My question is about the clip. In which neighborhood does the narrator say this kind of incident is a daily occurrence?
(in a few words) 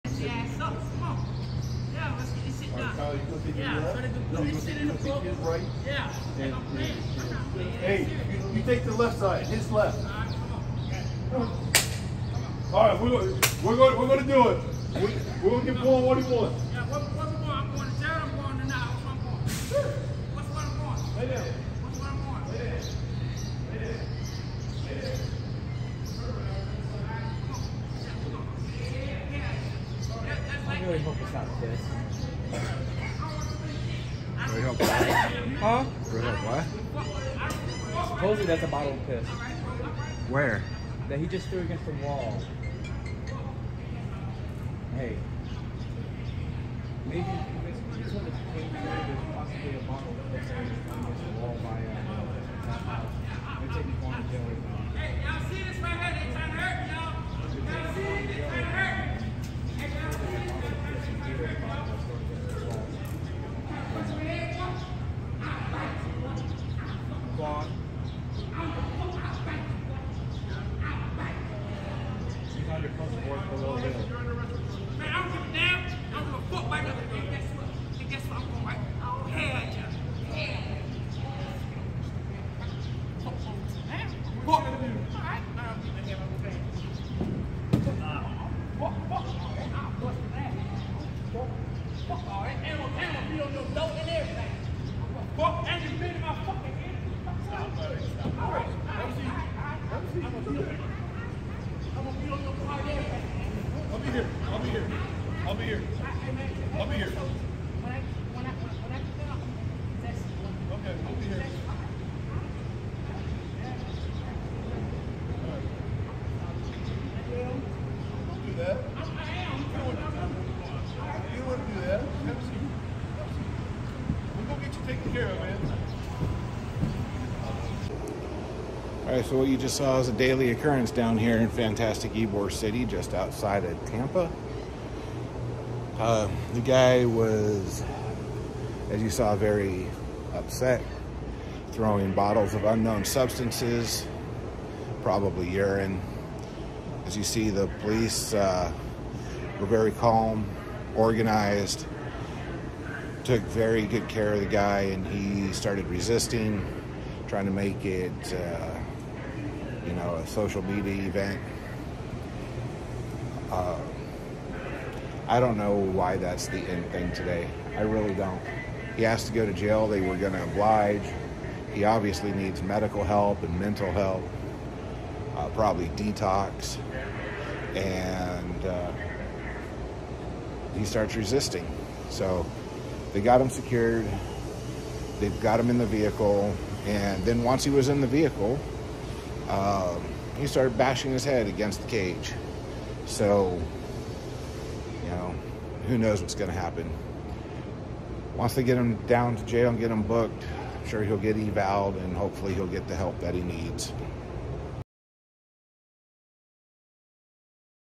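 Ybor City.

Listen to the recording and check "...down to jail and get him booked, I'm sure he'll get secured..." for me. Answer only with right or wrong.
wrong.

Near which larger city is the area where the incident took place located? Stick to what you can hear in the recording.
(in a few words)
Tampa.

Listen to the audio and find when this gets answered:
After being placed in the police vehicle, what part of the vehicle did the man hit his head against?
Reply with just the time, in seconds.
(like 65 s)
191 s.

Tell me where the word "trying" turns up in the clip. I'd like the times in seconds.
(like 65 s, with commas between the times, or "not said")
3 s, 157 s.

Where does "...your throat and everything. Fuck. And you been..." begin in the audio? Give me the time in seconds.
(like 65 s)
93 s.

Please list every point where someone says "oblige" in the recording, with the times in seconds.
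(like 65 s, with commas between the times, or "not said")
170 s.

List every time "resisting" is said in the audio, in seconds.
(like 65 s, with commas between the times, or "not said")
155 s, 181 s.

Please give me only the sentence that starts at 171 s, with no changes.
He obviously needs medical help and mental help, uh, probably detox.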